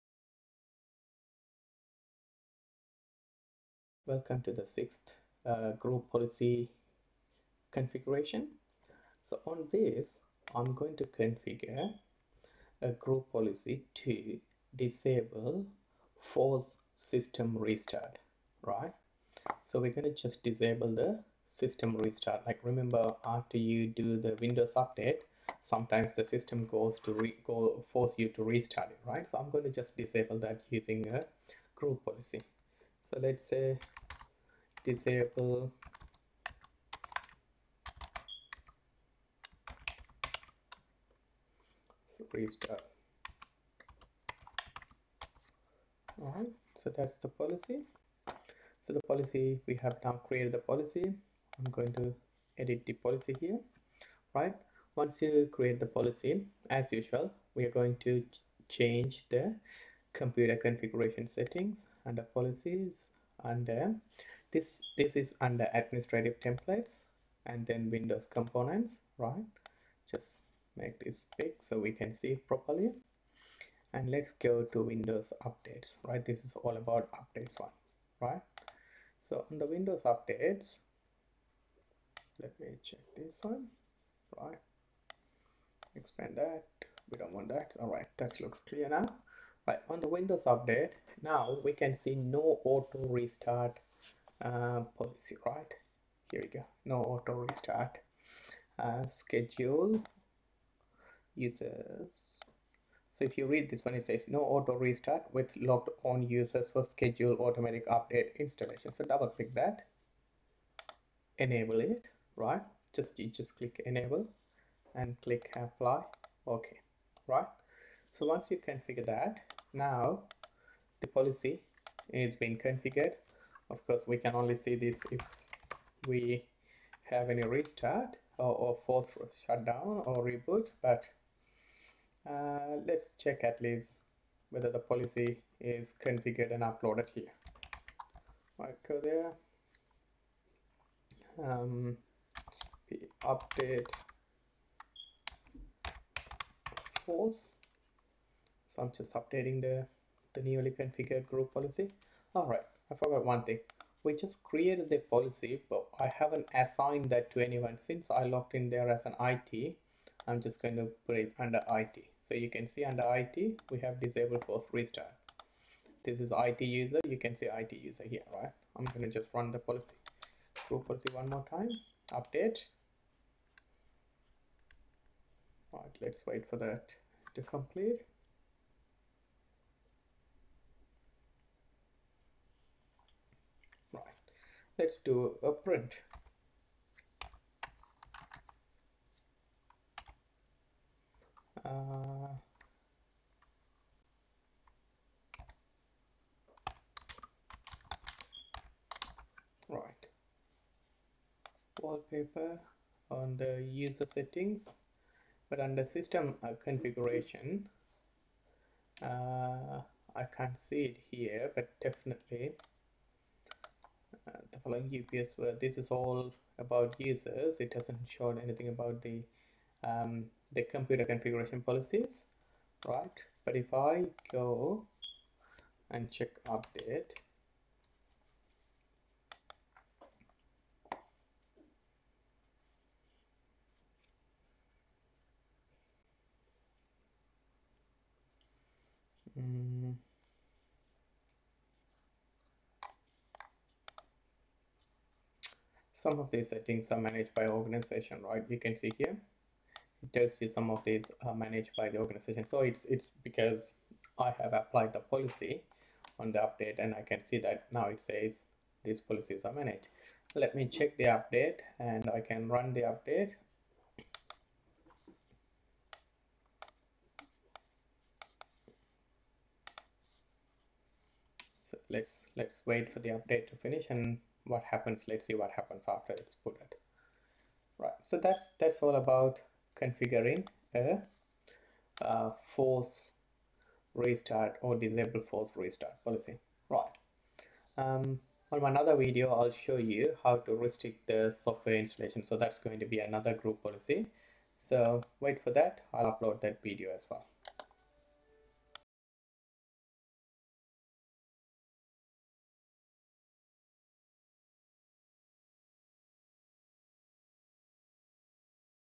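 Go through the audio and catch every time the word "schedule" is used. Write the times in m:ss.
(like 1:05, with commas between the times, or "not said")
1:39, 1:46.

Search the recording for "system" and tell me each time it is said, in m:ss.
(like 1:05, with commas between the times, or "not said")
0:16, 0:21, 0:26, 3:25.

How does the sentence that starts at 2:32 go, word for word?
All right, I forgot one thing.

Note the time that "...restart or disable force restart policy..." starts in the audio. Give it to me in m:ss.
4:43.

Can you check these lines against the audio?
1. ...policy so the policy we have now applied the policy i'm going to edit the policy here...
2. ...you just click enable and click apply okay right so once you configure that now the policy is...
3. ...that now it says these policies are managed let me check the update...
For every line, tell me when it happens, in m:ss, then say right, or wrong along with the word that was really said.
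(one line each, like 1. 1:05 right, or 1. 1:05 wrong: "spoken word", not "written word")
1. 0:47 wrong: "created", not "applied"
2. 1:53 right
3. 4:17 right.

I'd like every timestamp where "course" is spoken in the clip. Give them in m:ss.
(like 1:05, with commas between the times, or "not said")
2:03.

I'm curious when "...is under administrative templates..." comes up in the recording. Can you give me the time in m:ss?
1:05.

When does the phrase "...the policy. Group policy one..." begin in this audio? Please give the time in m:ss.
2:49.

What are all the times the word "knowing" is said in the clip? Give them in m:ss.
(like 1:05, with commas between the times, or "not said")
not said.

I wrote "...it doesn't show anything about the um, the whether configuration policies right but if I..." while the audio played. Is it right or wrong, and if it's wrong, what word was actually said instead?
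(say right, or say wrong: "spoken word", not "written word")
wrong: "computer", not "whether".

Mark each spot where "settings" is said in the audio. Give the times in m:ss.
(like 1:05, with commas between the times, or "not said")
1:01, 3:24, 4:06.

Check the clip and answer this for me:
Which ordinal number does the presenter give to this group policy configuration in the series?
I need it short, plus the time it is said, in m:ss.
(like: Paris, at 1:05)
Sixth, at 0:04.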